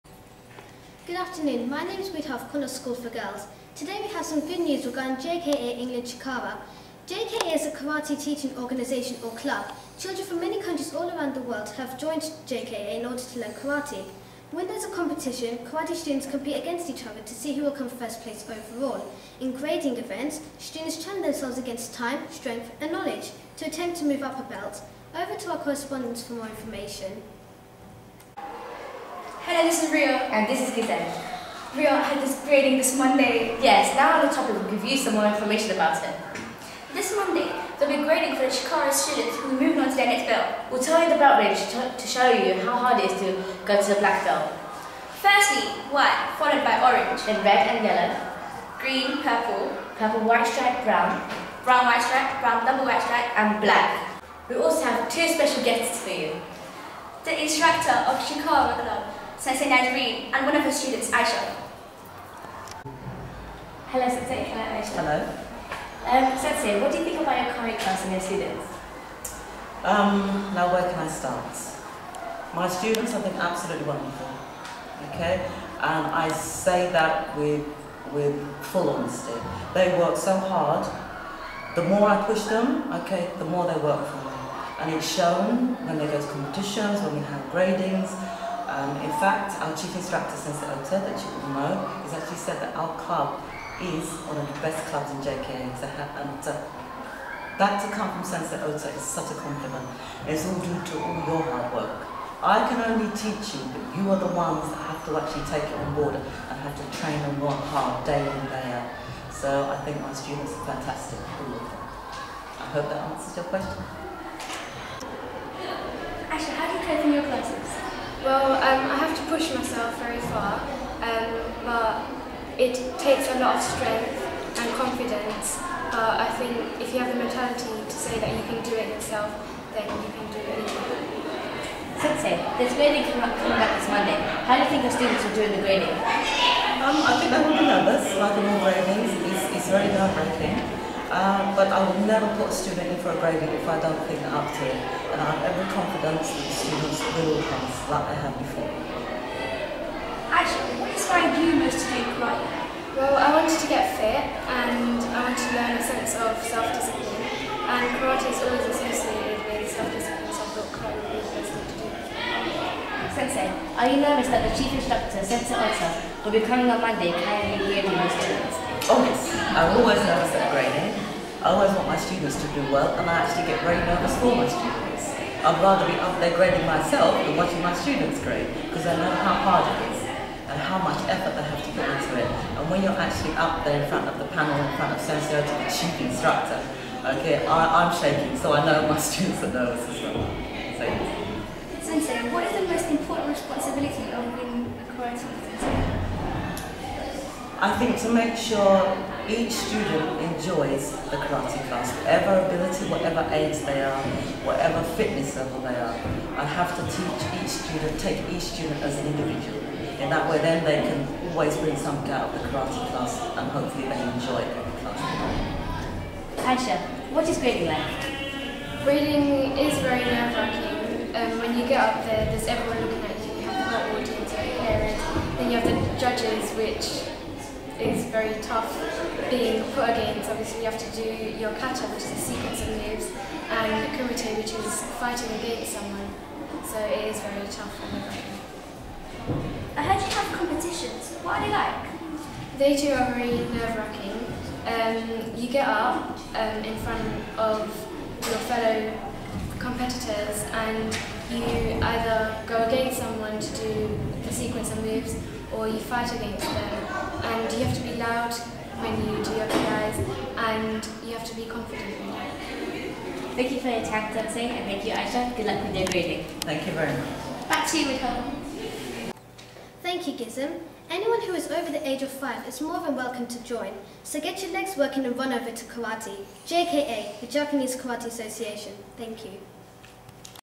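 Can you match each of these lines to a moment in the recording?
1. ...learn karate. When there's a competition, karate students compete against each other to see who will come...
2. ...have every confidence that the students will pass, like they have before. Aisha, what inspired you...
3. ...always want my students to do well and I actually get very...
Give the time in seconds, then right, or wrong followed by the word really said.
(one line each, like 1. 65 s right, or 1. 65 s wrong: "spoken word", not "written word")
1. 13 s right
2. 145 s right
3. 171 s right.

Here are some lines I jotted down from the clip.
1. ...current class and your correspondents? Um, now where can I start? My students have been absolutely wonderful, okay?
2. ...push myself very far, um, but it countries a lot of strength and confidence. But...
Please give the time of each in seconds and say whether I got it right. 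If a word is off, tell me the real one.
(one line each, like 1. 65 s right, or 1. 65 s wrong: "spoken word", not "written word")
1. 67 s wrong: "students", not "correspondents"
2. 119 s wrong: "takes", not "countries".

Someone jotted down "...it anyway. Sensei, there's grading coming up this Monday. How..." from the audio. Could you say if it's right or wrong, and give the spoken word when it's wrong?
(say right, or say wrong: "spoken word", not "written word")
right.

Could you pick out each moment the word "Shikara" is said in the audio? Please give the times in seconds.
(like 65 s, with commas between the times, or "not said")
38 s, 58 s.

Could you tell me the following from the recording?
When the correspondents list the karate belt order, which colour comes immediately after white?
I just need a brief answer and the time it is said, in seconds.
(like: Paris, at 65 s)
Orange, at 46 s.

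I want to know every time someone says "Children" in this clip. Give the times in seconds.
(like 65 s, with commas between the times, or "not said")
9 s.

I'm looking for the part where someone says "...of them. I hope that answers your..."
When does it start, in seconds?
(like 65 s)
111 s.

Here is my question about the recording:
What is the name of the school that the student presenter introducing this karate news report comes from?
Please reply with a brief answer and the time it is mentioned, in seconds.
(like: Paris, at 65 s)
Connaught School for Girls, at 2 s.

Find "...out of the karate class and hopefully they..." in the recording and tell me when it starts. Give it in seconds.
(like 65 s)
212 s.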